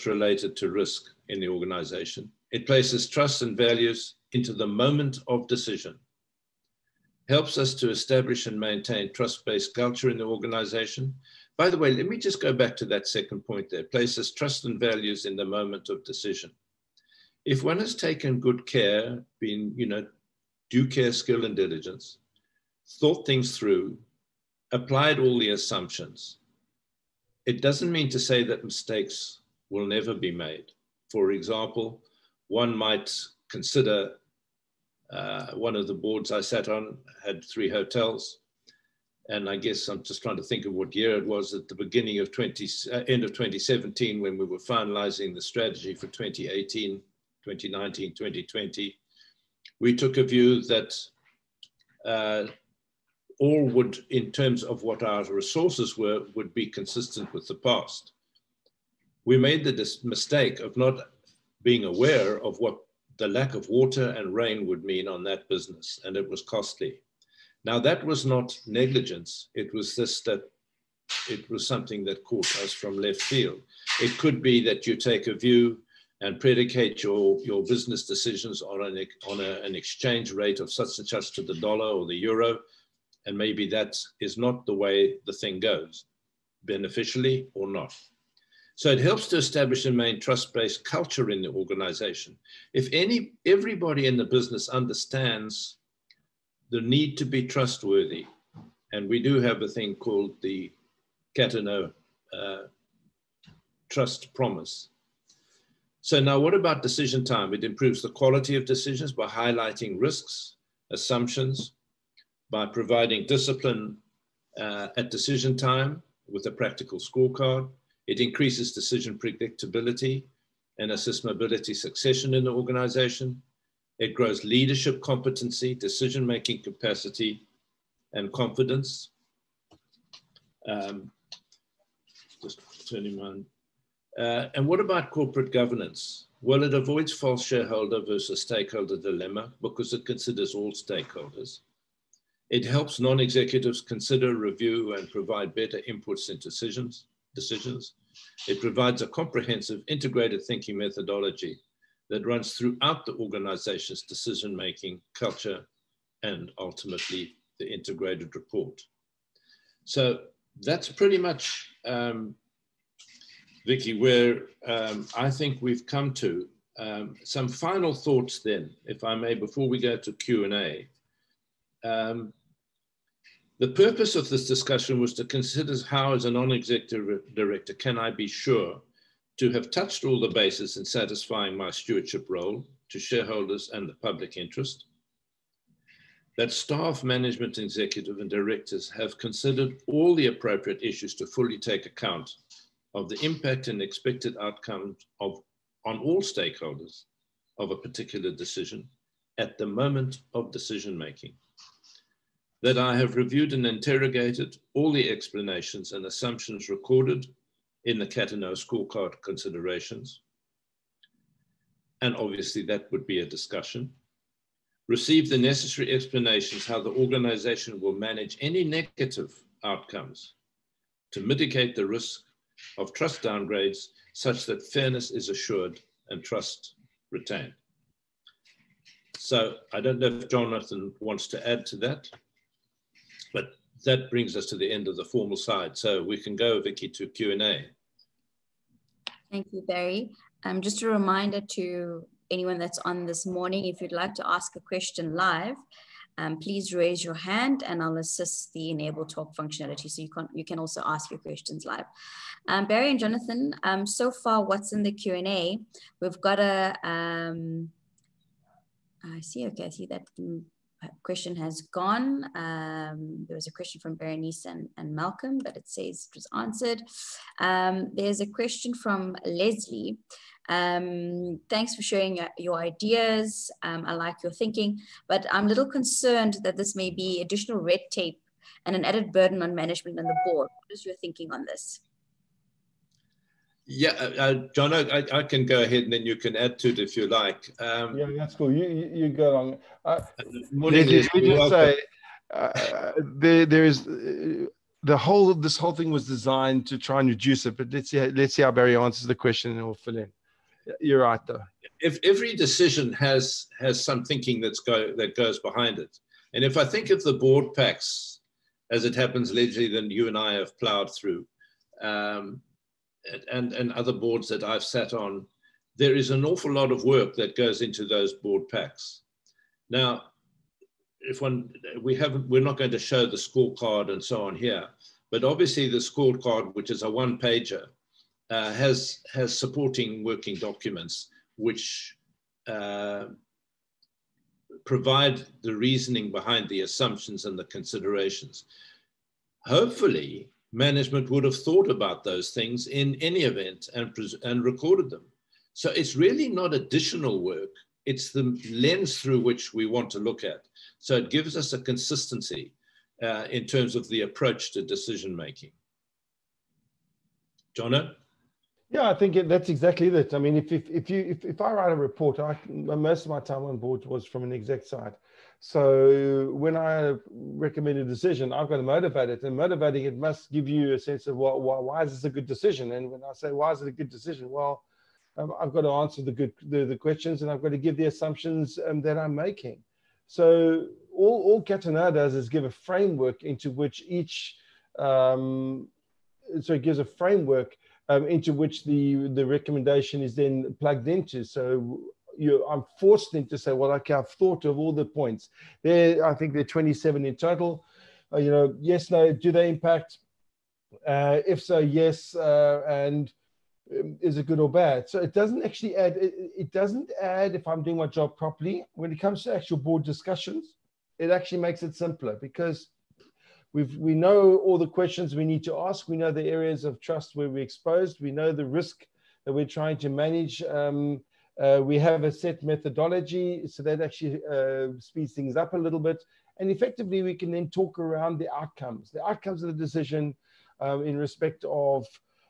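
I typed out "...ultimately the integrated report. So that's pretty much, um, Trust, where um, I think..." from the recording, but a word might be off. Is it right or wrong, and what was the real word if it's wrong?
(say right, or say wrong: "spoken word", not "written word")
wrong: "Vicky", not "Trust".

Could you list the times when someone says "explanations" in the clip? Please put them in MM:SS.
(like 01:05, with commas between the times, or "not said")
03:25, 03:35.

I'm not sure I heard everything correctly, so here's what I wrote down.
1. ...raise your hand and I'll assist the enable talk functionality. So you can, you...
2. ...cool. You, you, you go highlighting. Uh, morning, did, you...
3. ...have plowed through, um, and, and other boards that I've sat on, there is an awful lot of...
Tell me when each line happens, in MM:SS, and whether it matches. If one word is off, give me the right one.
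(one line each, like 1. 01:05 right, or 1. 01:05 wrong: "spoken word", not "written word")
1. 04:06 right
2. 04:48 wrong: "along", not "highlighting"
3. 05:10 right.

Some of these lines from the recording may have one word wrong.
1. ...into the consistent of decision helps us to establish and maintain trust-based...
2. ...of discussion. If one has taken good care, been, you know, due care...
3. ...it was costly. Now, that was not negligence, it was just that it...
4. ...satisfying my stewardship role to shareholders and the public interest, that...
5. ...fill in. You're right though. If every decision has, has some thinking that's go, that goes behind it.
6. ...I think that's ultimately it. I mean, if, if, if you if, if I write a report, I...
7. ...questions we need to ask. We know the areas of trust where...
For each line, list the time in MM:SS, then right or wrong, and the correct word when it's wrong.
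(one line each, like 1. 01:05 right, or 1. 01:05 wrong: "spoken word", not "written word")
1. 00:04 wrong: "moment", not "consistent"
2. 00:15 wrong: "decision", not "discussion"
3. 01:06 right
4. 03:00 right
5. 04:59 right
6. 05:58 wrong: "exactly", not "ultimately"
7. 06:54 right.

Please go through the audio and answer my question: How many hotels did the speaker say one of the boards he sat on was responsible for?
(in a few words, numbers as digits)
3.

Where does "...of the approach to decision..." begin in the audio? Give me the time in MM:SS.
05:53.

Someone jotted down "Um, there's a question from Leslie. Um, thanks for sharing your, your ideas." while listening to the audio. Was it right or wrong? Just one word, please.
right.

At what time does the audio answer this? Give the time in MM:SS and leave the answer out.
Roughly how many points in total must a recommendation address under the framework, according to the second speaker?
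06:36.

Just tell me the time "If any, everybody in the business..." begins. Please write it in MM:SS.
01:32.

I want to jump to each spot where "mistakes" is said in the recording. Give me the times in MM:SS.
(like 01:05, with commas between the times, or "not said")
00:28, 01:00.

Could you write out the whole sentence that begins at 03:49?
So I don't know if Jonathan wants to add to that that brings us to the end of the formal side.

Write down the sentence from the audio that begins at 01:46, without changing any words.
So now what about decision time?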